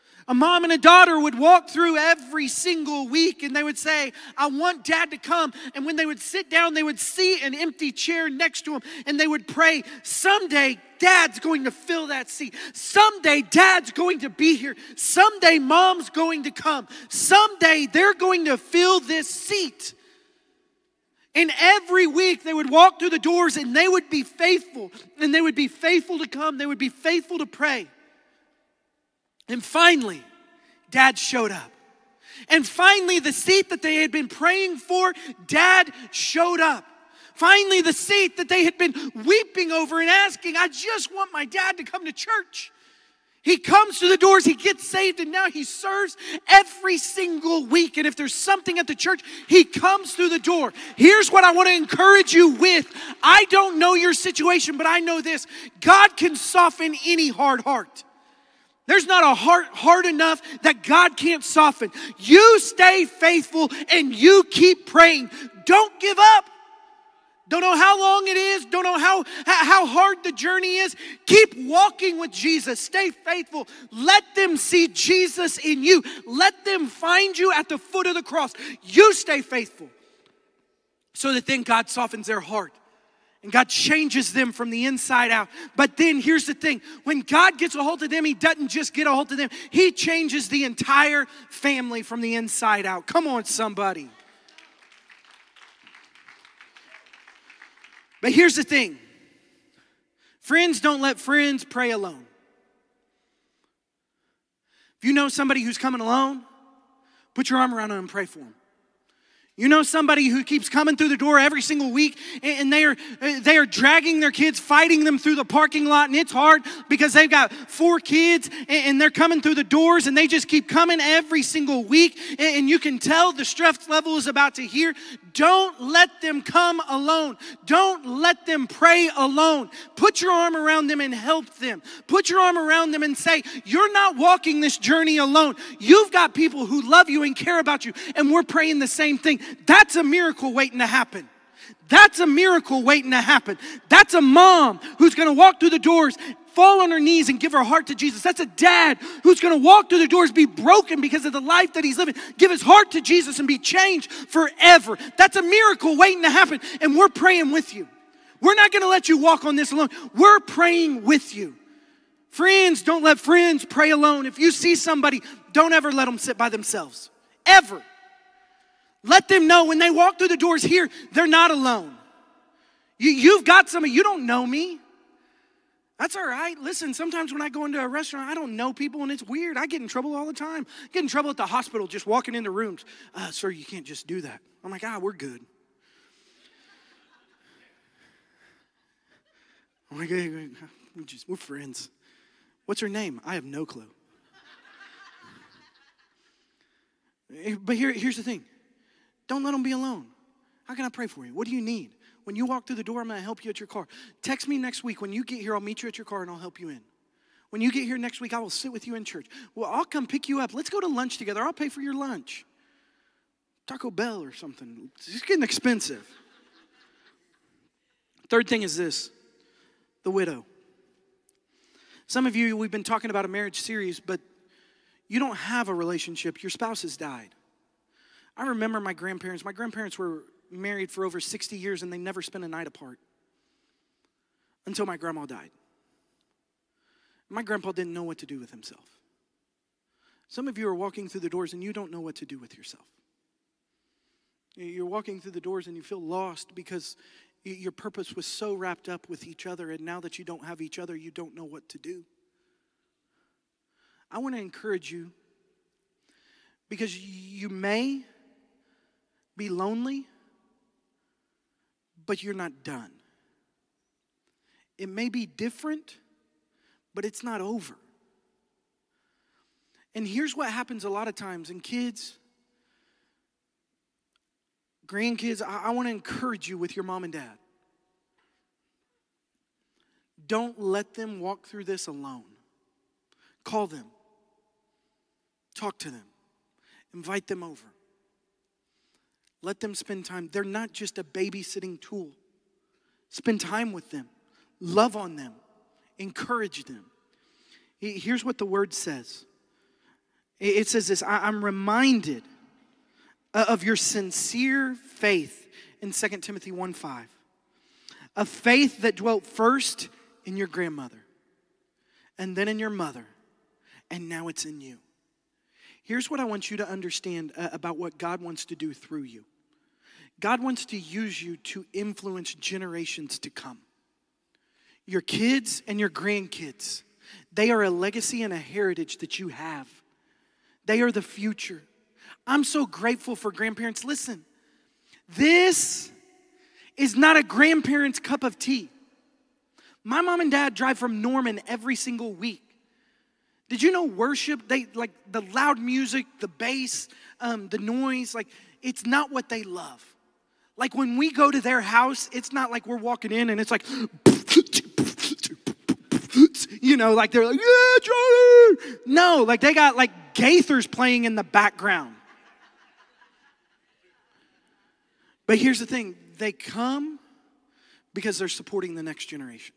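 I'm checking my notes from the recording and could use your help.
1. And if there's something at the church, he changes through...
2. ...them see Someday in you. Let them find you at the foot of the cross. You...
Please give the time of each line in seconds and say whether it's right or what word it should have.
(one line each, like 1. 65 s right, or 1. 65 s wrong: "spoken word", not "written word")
1. 47 s wrong: "comes", not "changes"
2. 74 s wrong: "Jesus", not "Someday".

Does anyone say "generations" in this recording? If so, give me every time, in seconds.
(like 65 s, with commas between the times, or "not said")
322 s, 369 s.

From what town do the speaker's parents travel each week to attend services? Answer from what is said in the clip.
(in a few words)
Norman.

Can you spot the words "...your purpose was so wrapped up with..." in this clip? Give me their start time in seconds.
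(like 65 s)
247 s.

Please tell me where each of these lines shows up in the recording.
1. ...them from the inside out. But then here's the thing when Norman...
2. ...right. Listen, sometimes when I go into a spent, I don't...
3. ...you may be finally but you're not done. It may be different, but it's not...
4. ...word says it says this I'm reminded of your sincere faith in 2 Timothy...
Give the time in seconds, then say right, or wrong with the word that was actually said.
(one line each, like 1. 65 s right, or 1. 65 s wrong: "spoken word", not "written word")
1. 84 s wrong: "God", not "Norman"
2. 176 s wrong: "restaurant", not "spent"
3. 256 s wrong: "lonely", not "finally"
4. 298 s right.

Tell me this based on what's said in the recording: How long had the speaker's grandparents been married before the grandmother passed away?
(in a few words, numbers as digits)
over 60 years.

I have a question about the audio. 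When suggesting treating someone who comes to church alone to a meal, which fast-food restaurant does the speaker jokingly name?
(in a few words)
Taco Bell.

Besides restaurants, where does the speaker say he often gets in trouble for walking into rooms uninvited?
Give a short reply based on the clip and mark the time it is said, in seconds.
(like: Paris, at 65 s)
the hospital, at 181 s.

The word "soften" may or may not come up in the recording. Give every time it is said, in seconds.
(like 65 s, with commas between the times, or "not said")
56 s, 61 s, 81 s.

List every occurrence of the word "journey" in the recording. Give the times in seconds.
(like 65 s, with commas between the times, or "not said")
70 s, 134 s.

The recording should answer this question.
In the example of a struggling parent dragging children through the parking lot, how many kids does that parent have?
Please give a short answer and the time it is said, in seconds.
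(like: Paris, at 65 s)
4, at 117 s.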